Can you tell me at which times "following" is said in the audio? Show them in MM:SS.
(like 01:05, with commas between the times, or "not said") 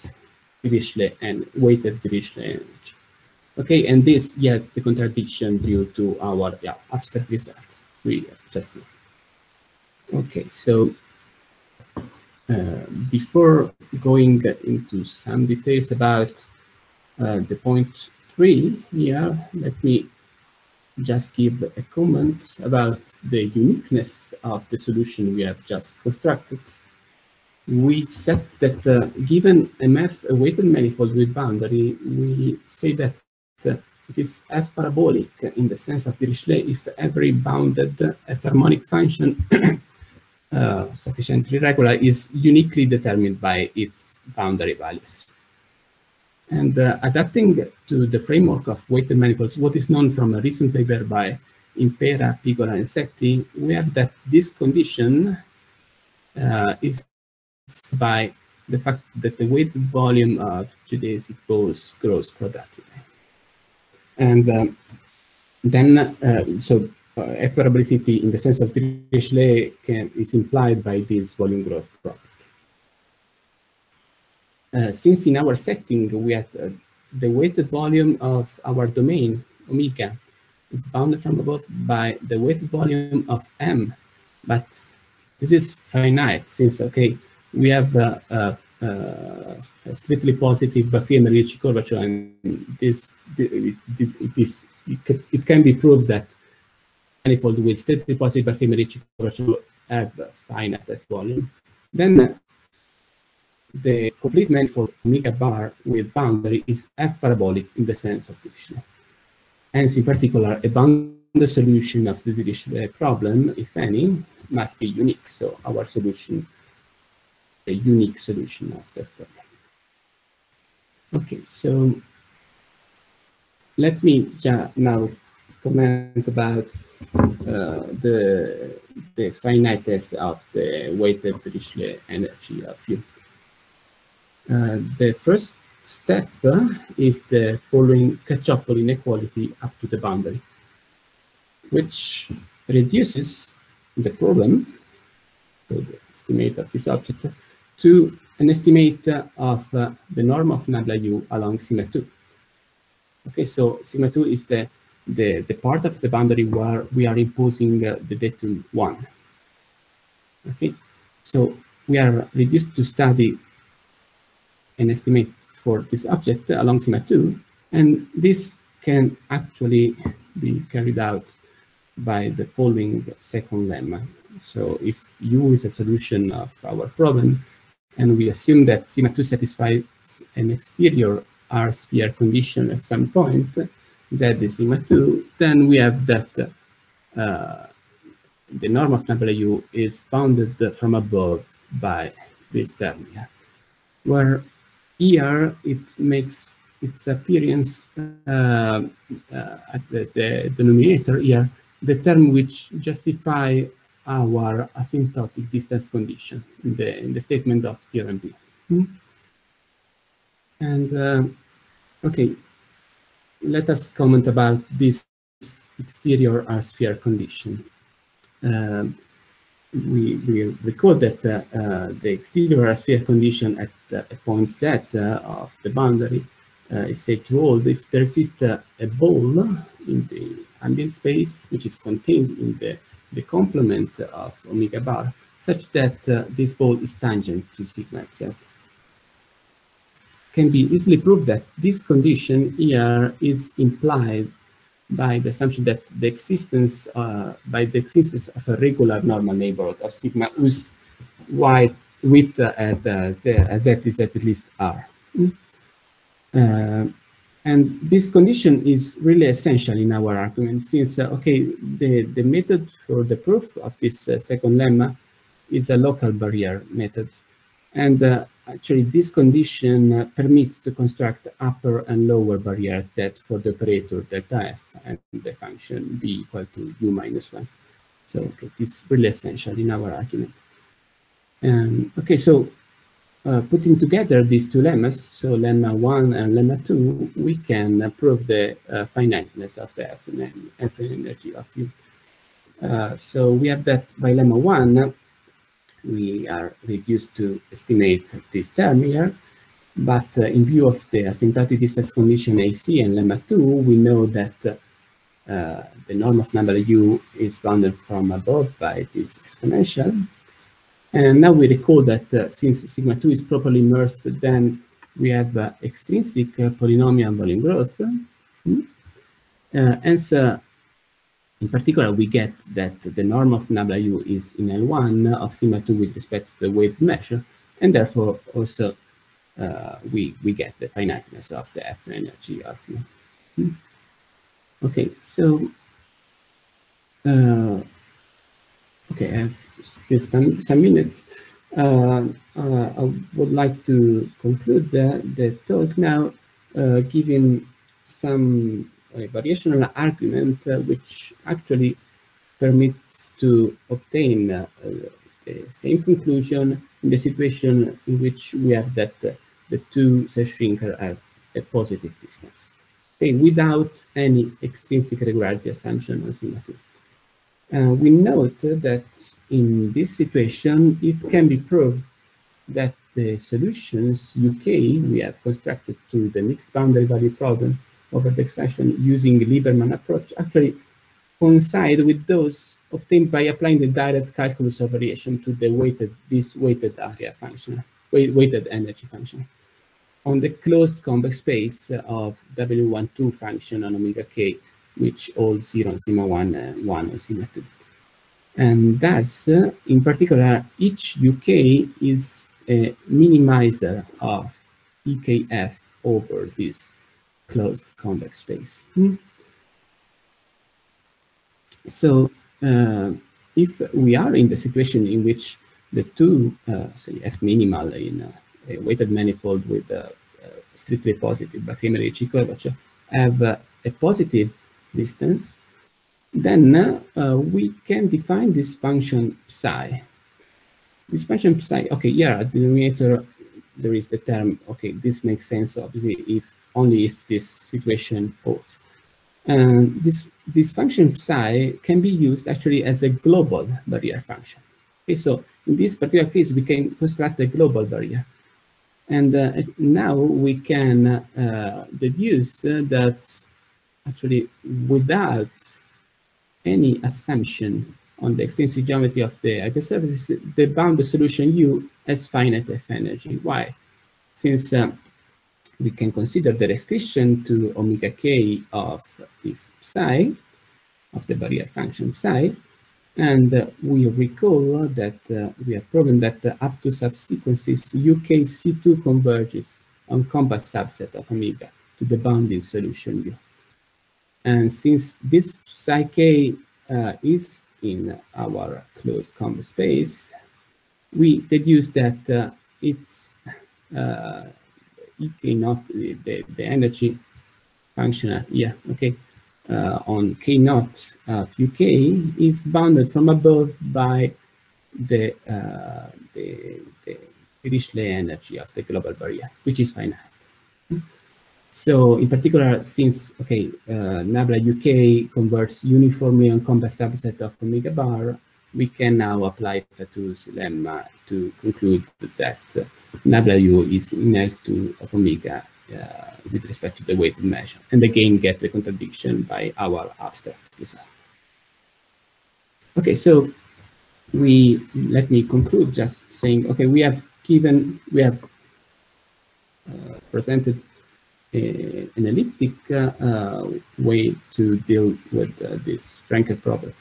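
02:17, 02:52.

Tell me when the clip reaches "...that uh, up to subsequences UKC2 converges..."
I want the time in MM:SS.
07:55.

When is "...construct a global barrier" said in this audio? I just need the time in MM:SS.
07:26.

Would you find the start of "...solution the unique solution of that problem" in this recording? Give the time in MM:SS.
01:55.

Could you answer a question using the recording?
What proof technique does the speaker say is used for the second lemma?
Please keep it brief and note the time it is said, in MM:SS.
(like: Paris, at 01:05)
Local barrier method, at 04:25.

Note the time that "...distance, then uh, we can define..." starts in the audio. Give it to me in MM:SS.
07:04.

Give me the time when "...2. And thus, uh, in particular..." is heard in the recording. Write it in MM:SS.
06:37.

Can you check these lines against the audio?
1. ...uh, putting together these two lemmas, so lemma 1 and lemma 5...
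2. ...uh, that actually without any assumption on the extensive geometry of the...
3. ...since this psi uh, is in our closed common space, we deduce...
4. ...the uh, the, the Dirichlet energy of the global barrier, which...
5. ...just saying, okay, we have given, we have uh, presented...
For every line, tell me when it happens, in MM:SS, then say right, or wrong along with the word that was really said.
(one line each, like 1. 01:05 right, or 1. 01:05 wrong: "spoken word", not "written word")
1. 04:43 wrong: "2", not "5"
2. 07:32 right
3. 08:04 right
4. 08:24 right
5. 08:55 right.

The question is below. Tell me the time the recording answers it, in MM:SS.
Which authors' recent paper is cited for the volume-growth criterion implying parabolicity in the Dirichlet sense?
00:51.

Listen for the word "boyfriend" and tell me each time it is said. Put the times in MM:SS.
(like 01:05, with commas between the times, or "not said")
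not said.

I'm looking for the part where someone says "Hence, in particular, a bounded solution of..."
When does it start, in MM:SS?
01:49.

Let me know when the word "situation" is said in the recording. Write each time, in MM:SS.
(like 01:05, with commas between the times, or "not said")
05:56, 06:09, 06:54, 07:17.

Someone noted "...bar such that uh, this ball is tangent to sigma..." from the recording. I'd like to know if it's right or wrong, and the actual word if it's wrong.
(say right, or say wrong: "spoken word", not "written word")
right.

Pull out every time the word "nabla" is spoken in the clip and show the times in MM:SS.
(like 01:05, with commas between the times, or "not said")
02:30, 05:06, 08:34, 08:43.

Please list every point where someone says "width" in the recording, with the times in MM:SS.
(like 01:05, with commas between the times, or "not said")
04:12.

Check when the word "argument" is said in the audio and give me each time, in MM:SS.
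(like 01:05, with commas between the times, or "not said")
04:20, 04:40, 05:49.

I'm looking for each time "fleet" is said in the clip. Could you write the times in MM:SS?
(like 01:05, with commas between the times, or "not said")
not said.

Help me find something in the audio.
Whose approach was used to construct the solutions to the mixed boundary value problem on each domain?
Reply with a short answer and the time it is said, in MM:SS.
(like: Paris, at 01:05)
Lieberman, at 06:19.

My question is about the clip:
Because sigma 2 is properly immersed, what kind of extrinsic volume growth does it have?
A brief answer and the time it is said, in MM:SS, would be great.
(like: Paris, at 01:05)
Polynomial volume growth, at 05:16.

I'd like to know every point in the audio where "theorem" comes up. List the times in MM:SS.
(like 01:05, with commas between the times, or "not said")
03:27.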